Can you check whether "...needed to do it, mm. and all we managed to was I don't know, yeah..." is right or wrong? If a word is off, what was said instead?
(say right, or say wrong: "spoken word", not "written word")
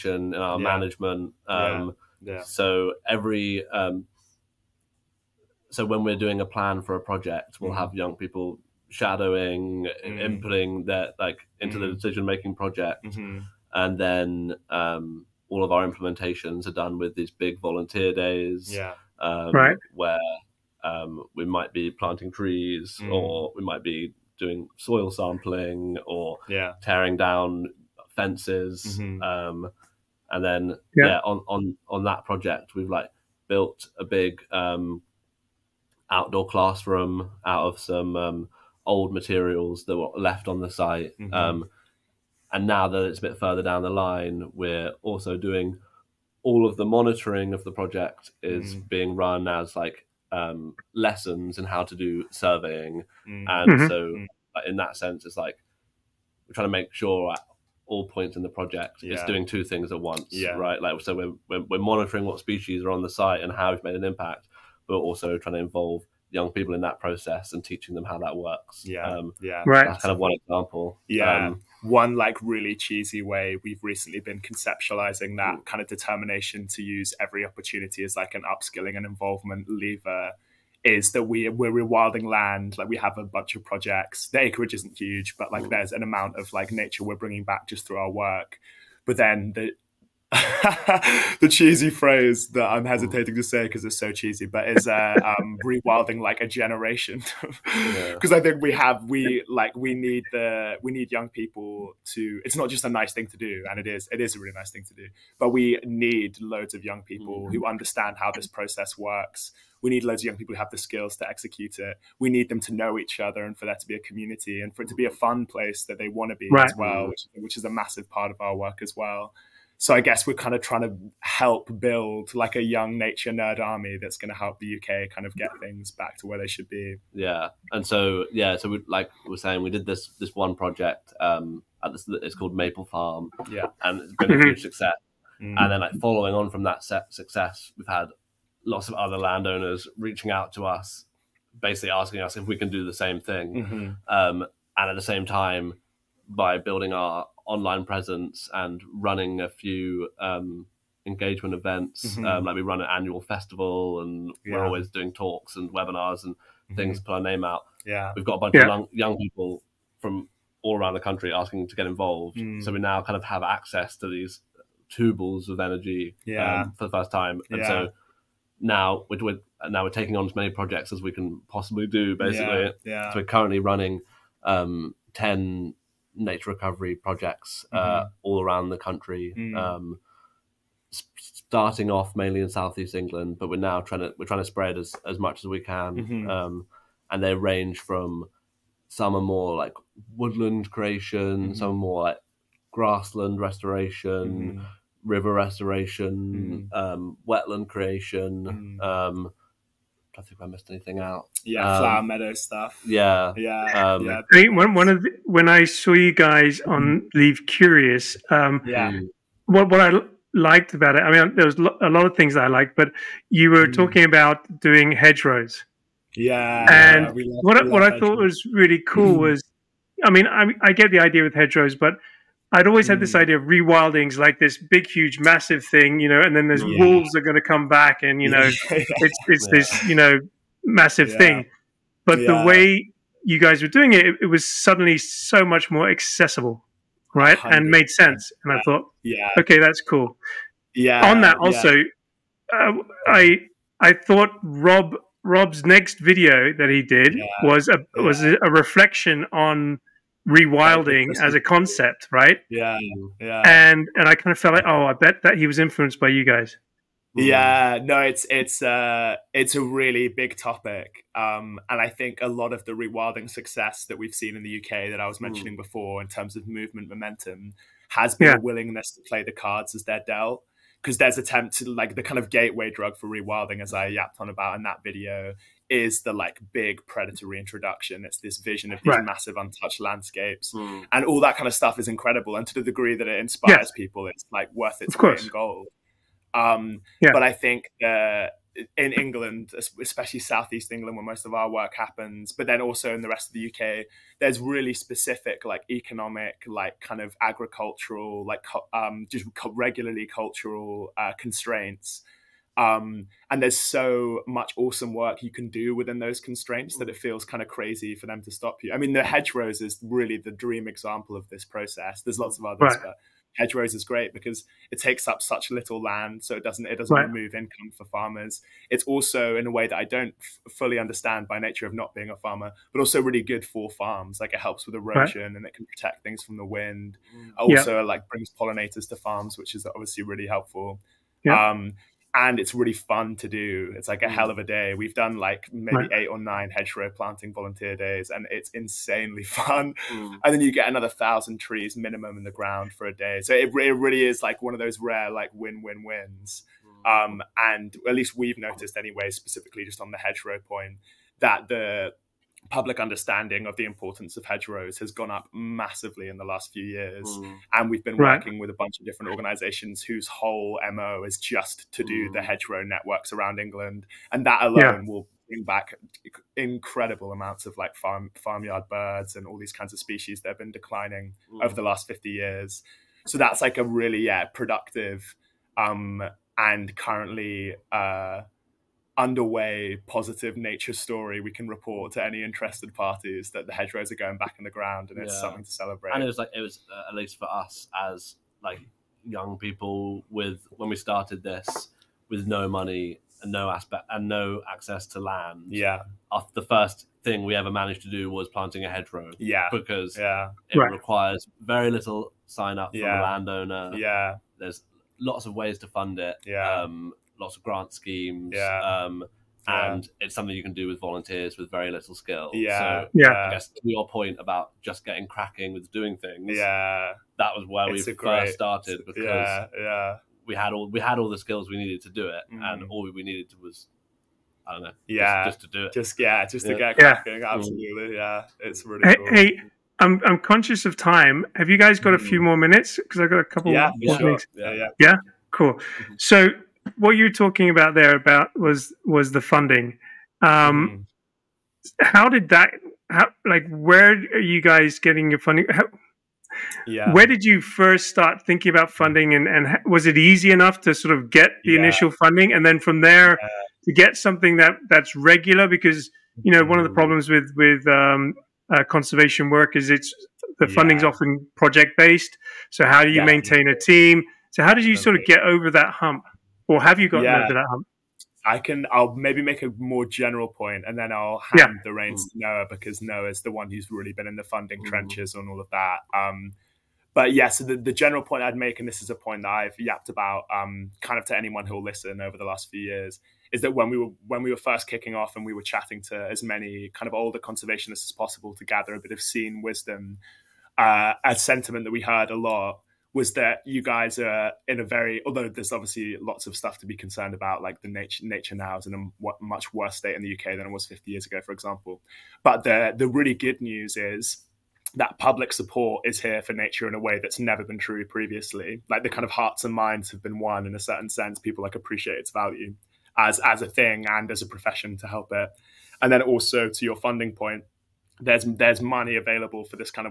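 wrong: "needed", not "managed".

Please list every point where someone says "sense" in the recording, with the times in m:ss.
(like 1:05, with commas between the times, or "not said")
0:54, 3:57, 8:30.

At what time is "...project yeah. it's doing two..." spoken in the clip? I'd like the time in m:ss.
0:58.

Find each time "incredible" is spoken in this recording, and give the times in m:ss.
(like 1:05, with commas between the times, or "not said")
4:41, 6:06.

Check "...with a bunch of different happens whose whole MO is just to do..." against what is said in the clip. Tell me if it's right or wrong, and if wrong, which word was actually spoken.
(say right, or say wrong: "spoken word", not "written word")
wrong: "organizations", not "happens".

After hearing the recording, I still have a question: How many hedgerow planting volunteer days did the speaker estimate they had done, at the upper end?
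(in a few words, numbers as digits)
9.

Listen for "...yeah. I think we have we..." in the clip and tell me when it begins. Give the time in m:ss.
1:38.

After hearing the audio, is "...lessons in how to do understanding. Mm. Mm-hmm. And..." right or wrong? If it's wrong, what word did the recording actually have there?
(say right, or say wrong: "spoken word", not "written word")
wrong: "surveying", not "understanding".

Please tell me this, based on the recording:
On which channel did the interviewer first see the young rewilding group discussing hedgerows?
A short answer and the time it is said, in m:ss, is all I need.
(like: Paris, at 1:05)
Leave Curious, at 3:27.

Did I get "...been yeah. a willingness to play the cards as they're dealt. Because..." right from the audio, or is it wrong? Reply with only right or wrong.
right.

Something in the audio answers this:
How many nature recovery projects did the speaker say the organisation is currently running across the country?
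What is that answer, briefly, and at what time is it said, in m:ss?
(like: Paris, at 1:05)
10, at 2:55.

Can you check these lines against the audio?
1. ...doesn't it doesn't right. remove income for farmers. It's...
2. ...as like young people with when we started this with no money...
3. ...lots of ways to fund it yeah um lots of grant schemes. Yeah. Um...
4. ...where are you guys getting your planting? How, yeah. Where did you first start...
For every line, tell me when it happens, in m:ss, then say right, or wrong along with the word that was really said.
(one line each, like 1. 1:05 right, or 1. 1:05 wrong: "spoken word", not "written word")
1. 5:16 right
2. 6:27 right
3. 6:44 right
4. 7:23 wrong: "funding", not "planting".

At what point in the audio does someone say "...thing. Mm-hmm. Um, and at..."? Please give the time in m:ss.
2:23.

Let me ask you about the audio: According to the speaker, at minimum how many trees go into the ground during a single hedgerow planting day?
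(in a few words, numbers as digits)
1000.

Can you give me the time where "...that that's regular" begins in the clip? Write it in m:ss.
7:34.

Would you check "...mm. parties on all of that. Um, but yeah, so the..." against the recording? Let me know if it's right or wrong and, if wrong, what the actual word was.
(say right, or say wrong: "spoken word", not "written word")
wrong: "trenches", not "parties".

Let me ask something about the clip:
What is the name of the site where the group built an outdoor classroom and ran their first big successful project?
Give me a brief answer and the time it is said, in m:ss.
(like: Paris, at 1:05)
Maple Farm, at 2:12.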